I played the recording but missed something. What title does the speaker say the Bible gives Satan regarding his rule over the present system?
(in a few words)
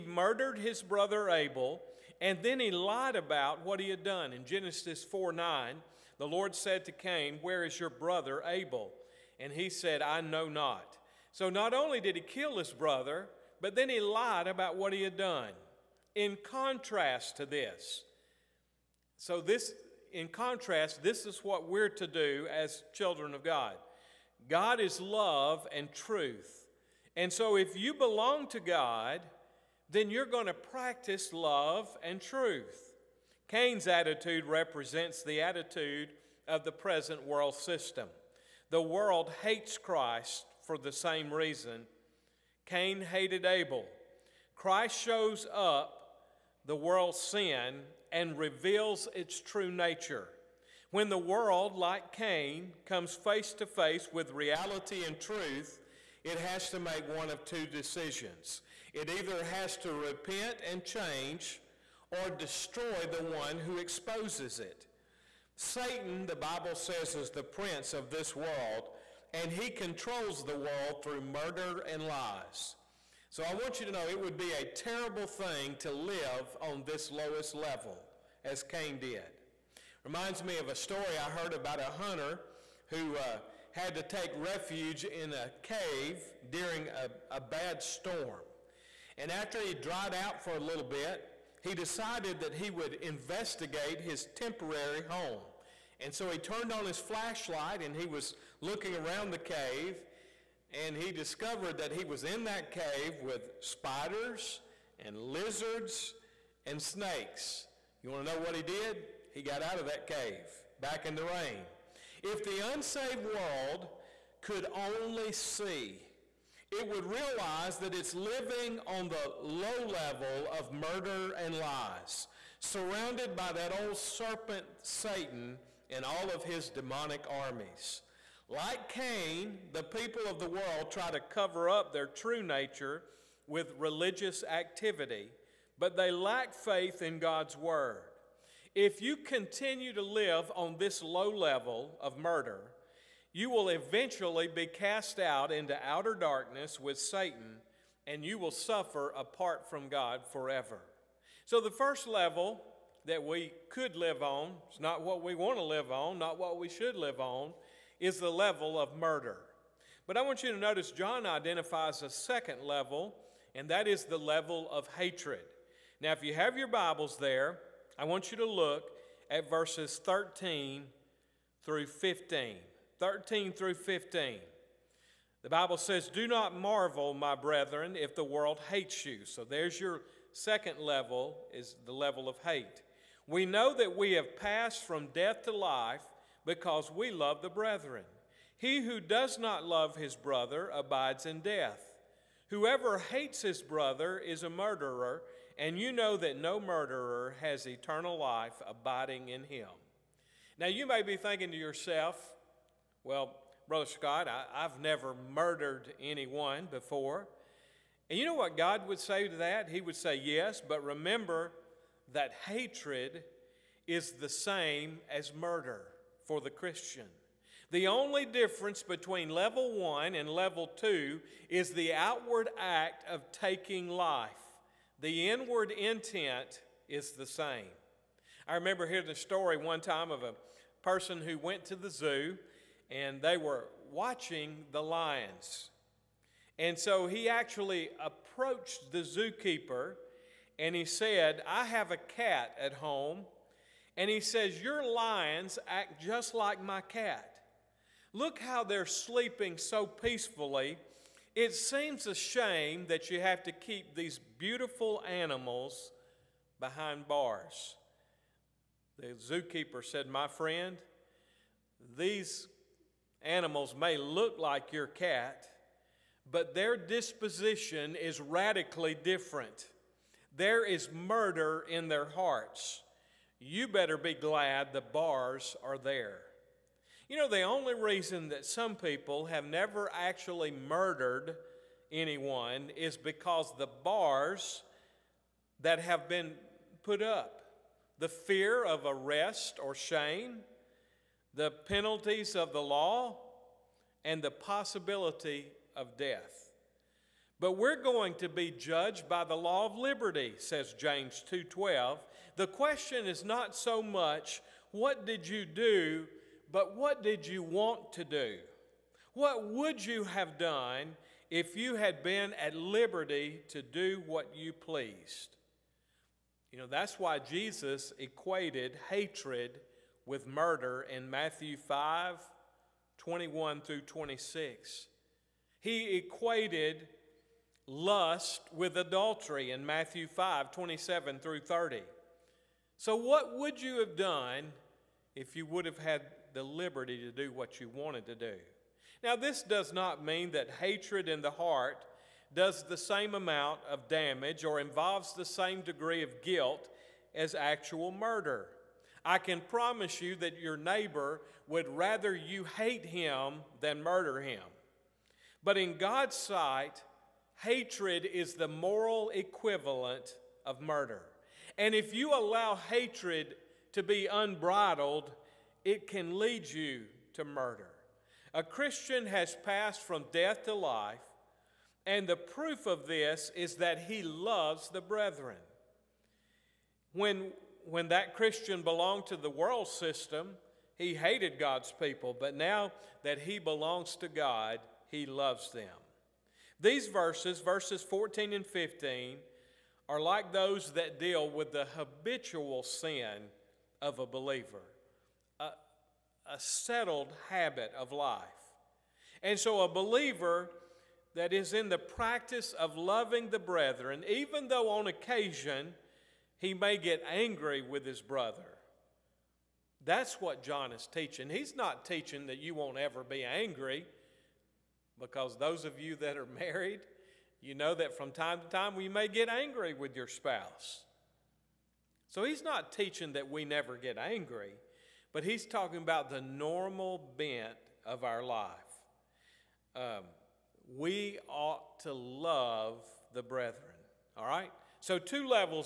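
prince of this world.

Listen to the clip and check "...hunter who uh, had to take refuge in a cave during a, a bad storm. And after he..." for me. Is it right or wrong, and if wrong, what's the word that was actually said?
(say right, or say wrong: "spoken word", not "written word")
right.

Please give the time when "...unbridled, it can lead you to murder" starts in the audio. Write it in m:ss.
6:04.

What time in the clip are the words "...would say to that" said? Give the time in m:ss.
3:28.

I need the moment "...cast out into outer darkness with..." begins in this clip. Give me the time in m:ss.
2:24.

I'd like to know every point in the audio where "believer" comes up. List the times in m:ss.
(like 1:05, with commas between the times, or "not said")
6:34, 6:39.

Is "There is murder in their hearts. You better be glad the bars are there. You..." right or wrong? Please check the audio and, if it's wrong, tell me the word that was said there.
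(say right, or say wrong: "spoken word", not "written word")
right.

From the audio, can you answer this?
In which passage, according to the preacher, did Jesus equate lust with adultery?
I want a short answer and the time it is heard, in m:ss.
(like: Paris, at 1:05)
Matthew 5:27-30, at 5:29.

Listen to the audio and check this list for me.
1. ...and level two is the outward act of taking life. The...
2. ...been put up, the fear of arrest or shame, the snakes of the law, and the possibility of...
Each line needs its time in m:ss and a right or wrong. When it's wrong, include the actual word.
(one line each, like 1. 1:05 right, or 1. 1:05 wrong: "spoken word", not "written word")
1. 3:40 right
2. 4:46 wrong: "penalties", not "snakes".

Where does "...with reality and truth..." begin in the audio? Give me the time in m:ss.
0:54.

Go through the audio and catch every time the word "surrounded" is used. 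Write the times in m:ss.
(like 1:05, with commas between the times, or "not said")
2:02.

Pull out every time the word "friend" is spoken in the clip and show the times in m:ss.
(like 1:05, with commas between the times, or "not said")
4:20.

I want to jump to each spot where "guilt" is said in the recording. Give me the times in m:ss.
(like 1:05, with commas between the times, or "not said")
5:46.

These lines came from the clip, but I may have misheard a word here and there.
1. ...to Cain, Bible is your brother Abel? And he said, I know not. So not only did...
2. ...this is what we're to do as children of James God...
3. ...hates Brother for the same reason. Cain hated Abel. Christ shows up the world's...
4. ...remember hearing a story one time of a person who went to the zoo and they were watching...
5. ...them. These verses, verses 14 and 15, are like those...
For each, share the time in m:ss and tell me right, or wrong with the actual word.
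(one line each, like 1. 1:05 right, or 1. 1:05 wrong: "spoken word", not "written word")
1. 0:06 wrong: "Where", not "Bible"
2. 0:21 wrong: "God", not "James"
3. 0:39 wrong: "Christ", not "Brother"
4. 3:48 right
5. 6:25 right.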